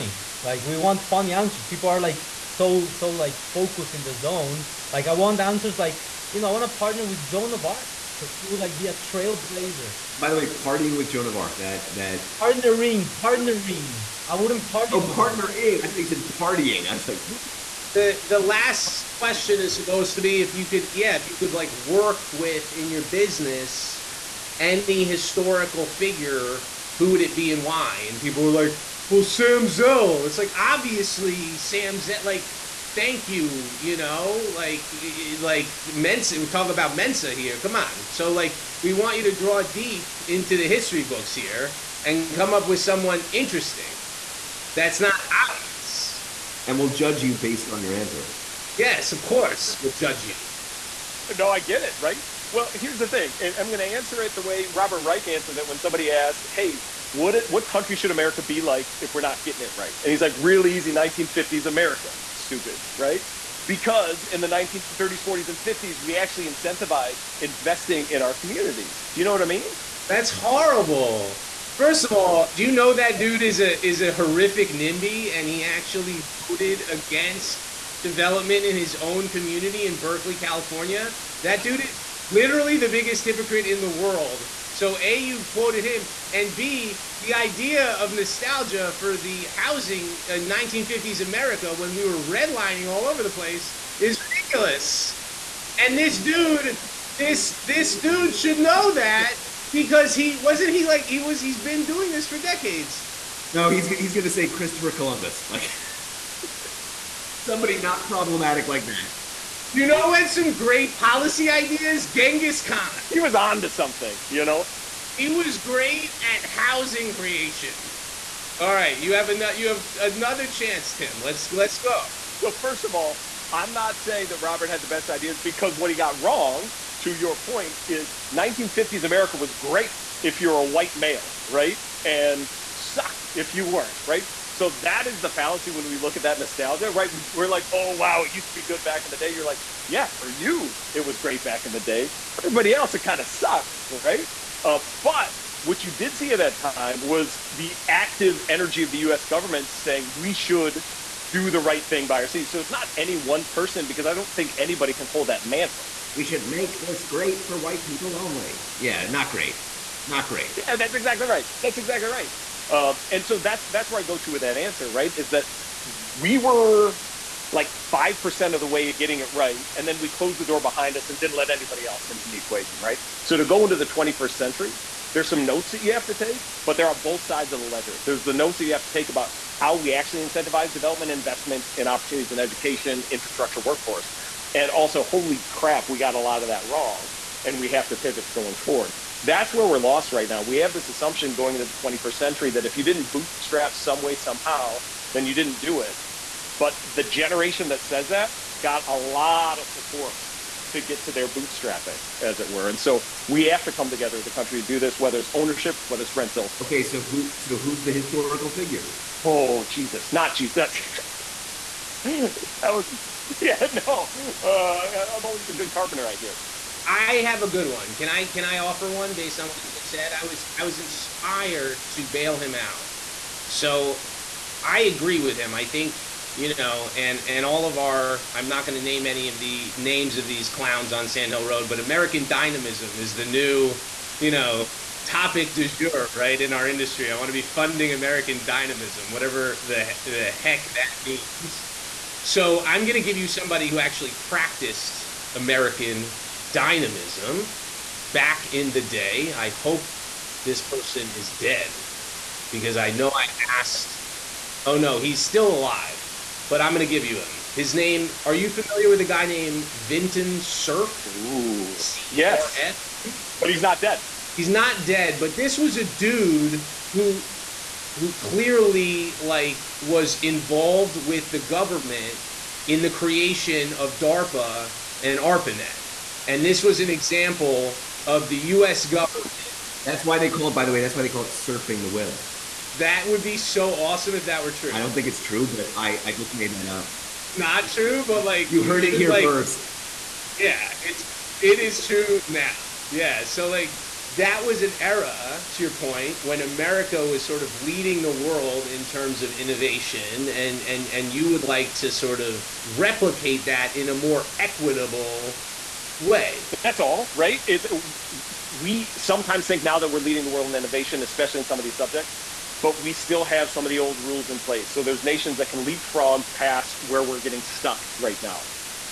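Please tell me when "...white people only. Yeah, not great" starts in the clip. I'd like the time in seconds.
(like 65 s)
157 s.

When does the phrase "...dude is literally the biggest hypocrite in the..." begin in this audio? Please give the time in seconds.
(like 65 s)
81 s.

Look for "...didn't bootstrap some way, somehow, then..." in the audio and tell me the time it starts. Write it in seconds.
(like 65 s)
192 s.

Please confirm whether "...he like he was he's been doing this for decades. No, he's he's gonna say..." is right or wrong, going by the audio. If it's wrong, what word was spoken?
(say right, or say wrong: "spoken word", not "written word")
right.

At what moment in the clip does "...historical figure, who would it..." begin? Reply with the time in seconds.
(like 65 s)
25 s.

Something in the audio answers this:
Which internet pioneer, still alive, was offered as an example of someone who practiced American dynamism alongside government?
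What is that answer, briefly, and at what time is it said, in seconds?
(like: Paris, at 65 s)
Vinton Cerf, at 259 s.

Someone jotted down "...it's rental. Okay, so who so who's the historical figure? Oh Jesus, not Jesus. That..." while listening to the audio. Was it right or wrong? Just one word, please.
right.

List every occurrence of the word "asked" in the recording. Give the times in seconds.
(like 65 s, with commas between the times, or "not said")
56 s, 253 s.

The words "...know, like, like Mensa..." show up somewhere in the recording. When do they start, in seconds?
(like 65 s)
33 s.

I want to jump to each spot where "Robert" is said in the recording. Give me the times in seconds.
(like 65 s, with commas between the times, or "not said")
54 s, 124 s.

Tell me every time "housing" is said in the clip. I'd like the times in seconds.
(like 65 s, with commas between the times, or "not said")
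89 s, 116 s.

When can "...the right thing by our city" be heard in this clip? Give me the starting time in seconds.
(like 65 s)
151 s.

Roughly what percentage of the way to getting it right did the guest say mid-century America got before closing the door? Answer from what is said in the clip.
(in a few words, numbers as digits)
5%.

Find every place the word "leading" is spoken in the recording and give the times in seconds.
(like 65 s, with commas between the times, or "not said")
297 s, 310 s.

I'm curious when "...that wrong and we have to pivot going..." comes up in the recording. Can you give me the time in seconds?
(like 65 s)
186 s.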